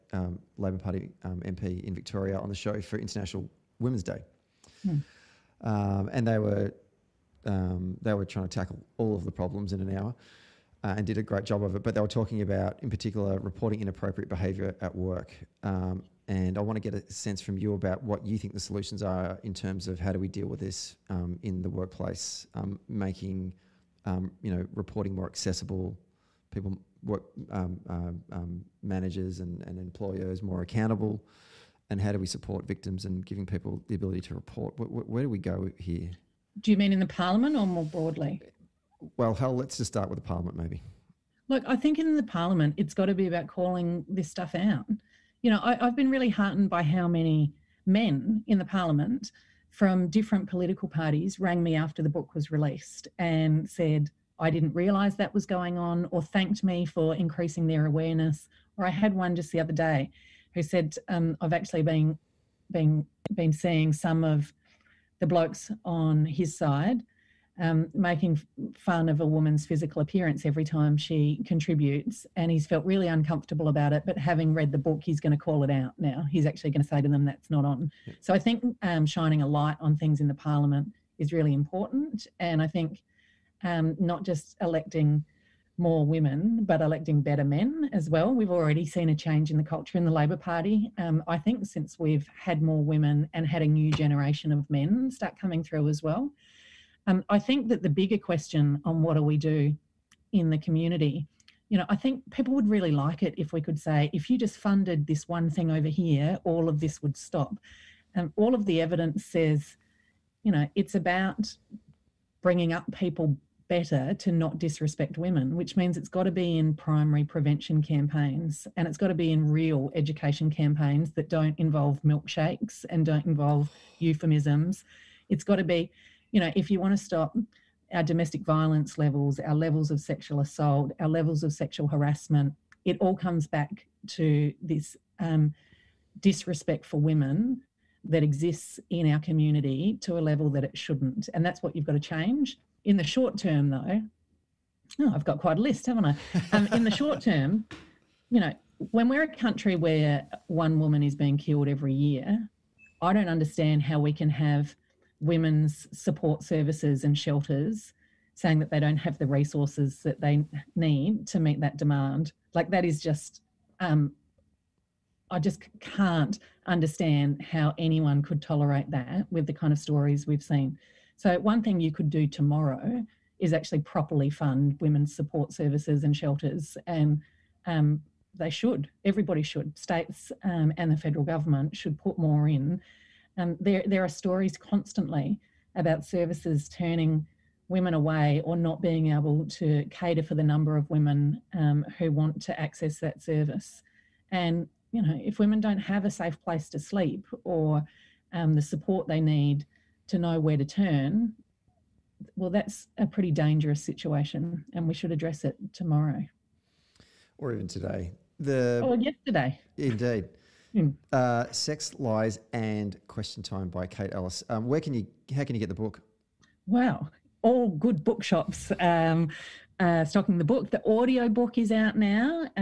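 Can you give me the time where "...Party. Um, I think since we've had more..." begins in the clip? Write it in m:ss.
1:30.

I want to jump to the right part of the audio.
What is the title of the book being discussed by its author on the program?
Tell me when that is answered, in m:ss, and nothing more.
3:31.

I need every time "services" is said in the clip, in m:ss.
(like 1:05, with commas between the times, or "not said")
2:36, 2:55, 3:06, 3:13.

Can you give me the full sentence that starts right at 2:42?
Like that is just, um, I just can't understand how anyone could tolerate that with the kind of stories we've seen.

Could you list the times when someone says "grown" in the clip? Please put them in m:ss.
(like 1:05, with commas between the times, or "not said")
not said.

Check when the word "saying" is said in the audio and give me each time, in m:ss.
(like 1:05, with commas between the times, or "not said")
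2:38.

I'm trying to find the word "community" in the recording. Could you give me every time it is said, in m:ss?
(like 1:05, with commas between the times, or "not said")
1:40, 2:19.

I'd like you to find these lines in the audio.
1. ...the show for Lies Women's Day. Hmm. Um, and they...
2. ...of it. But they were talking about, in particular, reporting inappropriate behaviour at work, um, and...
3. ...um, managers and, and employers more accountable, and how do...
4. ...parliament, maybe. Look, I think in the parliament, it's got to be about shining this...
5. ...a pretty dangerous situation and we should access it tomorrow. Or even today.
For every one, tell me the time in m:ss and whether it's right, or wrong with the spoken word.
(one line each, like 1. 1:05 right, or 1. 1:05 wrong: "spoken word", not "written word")
1. 0:02 wrong: "International", not "Lies"
2. 0:11 right
3. 0:27 right
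4. 0:40 wrong: "calling", not "shining"
5. 3:22 wrong: "address", not "access".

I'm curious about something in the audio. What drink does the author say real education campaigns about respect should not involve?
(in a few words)
milkshakes.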